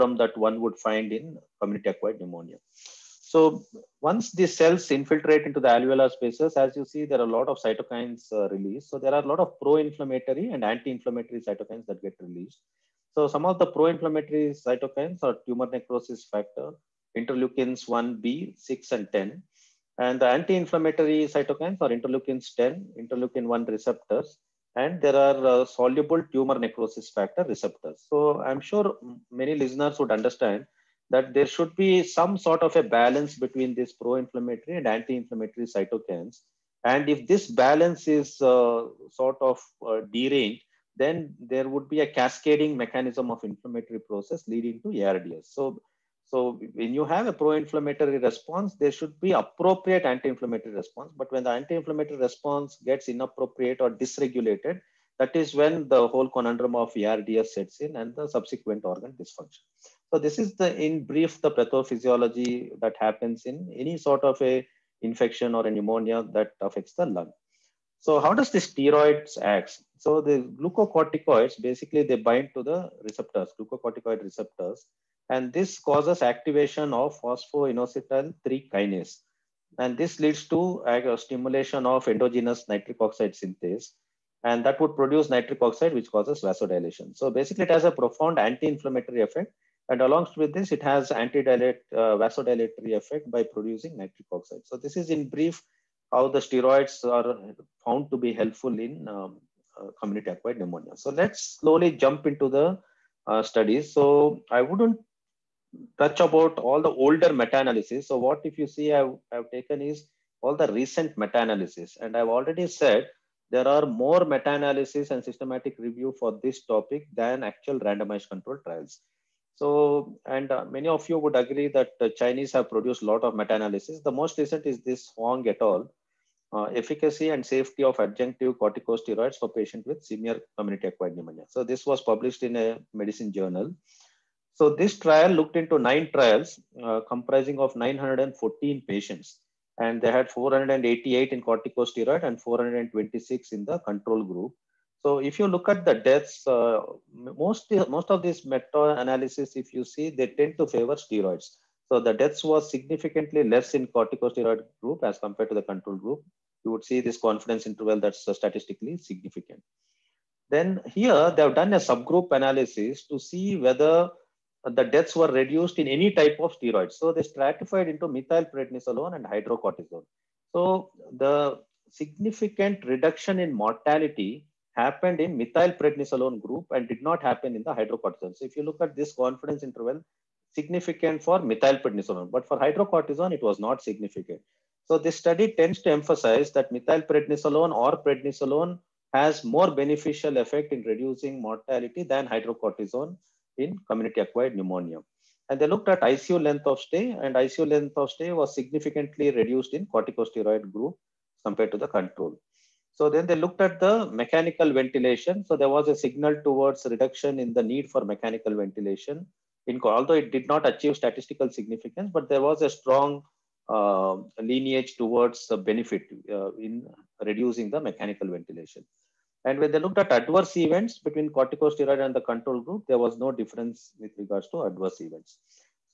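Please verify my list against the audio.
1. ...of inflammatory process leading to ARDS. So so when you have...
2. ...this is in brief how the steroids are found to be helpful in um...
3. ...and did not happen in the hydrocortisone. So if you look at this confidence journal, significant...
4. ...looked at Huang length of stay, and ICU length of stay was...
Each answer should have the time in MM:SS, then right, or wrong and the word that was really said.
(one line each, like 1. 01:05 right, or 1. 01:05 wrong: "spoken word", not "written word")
1. 00:43 right
2. 01:34 right
3. 02:56 wrong: "interval", not "journal"
4. 03:15 wrong: "ICU", not "Huang".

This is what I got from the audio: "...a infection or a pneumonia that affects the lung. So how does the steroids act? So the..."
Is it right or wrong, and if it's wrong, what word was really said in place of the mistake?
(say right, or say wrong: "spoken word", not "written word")
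right.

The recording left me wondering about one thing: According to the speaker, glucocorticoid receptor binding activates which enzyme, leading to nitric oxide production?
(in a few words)
Phosphoinositol 3 kinase.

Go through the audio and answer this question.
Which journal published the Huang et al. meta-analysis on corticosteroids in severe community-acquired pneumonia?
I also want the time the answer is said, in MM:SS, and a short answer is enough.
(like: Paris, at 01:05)
Medicine, at 02:12.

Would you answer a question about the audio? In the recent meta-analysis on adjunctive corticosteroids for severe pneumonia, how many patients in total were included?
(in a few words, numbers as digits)
914.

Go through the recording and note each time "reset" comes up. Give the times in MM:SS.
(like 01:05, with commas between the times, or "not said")
not said.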